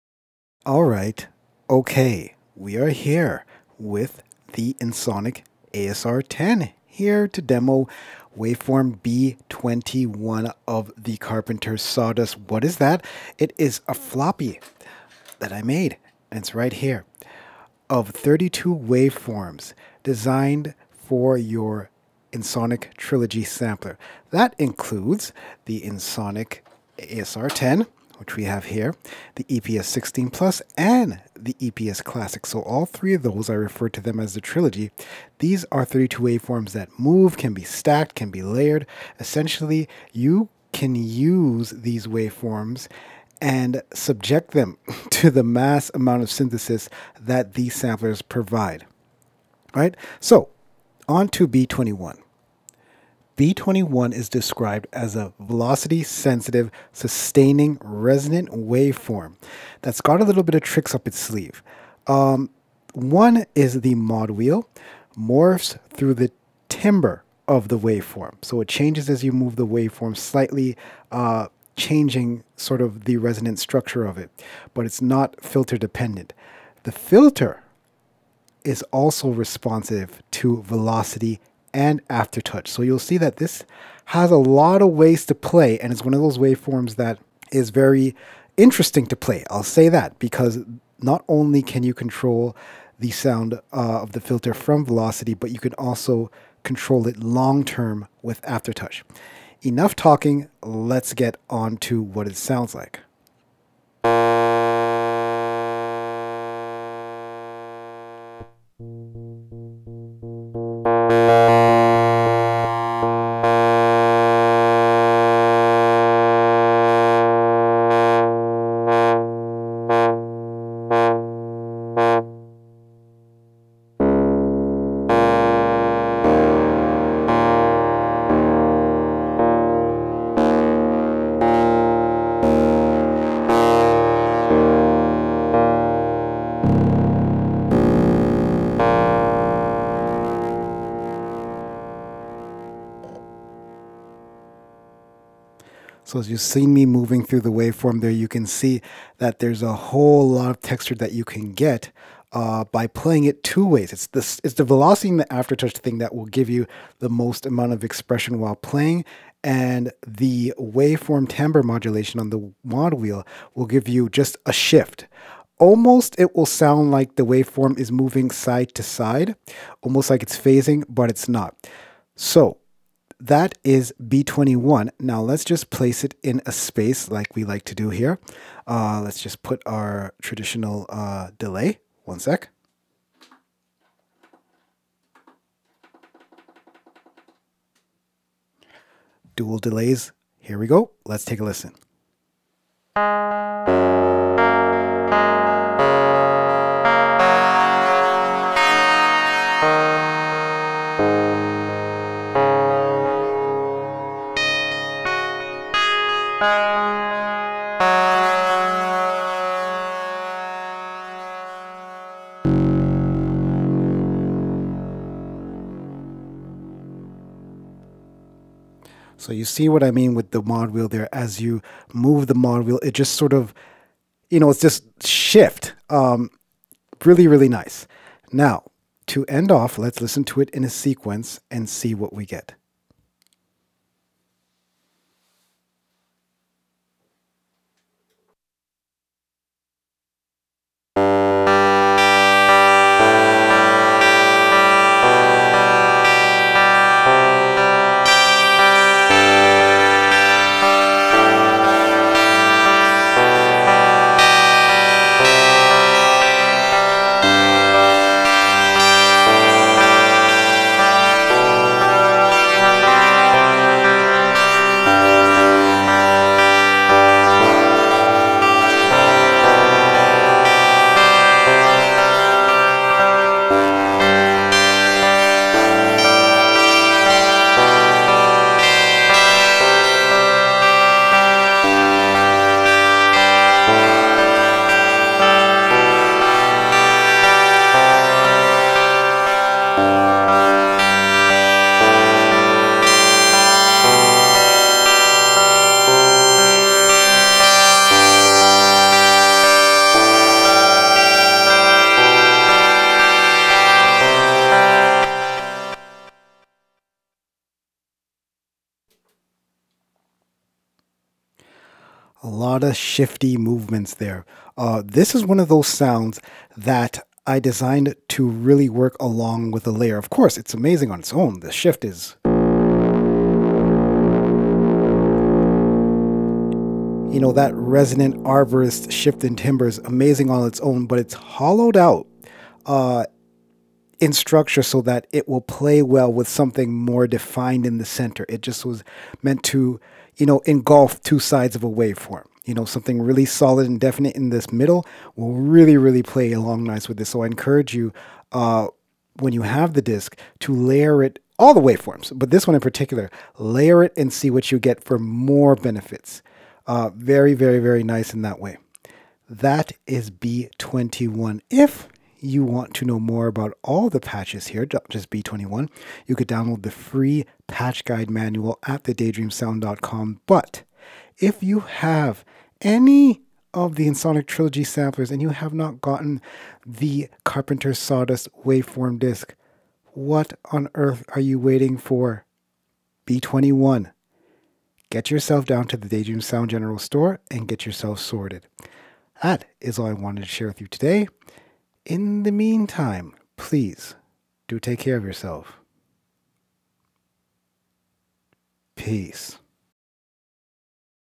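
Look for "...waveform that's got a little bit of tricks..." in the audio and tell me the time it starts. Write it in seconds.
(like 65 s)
58 s.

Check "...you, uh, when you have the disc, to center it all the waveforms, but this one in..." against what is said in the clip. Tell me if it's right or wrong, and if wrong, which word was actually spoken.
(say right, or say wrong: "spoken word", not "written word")
wrong: "layer", not "center".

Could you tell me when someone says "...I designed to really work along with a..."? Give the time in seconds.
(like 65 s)
317 s.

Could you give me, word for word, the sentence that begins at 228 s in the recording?
Now, to end off, let's listen to it in a sequence and see what we get.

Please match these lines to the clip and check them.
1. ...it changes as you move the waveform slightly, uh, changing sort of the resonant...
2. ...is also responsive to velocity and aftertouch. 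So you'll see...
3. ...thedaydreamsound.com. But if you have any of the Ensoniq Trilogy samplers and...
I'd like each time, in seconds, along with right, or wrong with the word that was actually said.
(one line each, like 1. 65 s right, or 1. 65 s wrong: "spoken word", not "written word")
1. 68 s right
2. 78 s right
3. 368 s right.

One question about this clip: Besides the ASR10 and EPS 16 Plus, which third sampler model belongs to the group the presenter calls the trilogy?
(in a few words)
EPS Classic.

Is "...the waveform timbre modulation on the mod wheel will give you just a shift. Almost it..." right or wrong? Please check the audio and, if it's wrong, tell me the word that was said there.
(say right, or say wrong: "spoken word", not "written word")
right.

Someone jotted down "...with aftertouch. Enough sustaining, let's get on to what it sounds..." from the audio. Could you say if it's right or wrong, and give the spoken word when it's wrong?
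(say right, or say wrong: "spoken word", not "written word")
wrong: "talking", not "sustaining".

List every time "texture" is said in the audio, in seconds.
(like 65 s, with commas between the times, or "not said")
150 s.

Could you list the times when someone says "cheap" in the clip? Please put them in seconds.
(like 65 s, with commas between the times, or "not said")
not said.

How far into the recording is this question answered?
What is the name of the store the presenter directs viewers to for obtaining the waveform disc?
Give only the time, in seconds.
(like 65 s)
385 s.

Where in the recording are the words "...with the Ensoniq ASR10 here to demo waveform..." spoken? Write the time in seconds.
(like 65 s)
3 s.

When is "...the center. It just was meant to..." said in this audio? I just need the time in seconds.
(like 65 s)
337 s.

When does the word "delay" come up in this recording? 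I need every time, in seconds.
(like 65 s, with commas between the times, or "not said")
181 s, 189 s.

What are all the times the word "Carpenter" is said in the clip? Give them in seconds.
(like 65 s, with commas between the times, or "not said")
11 s, 377 s.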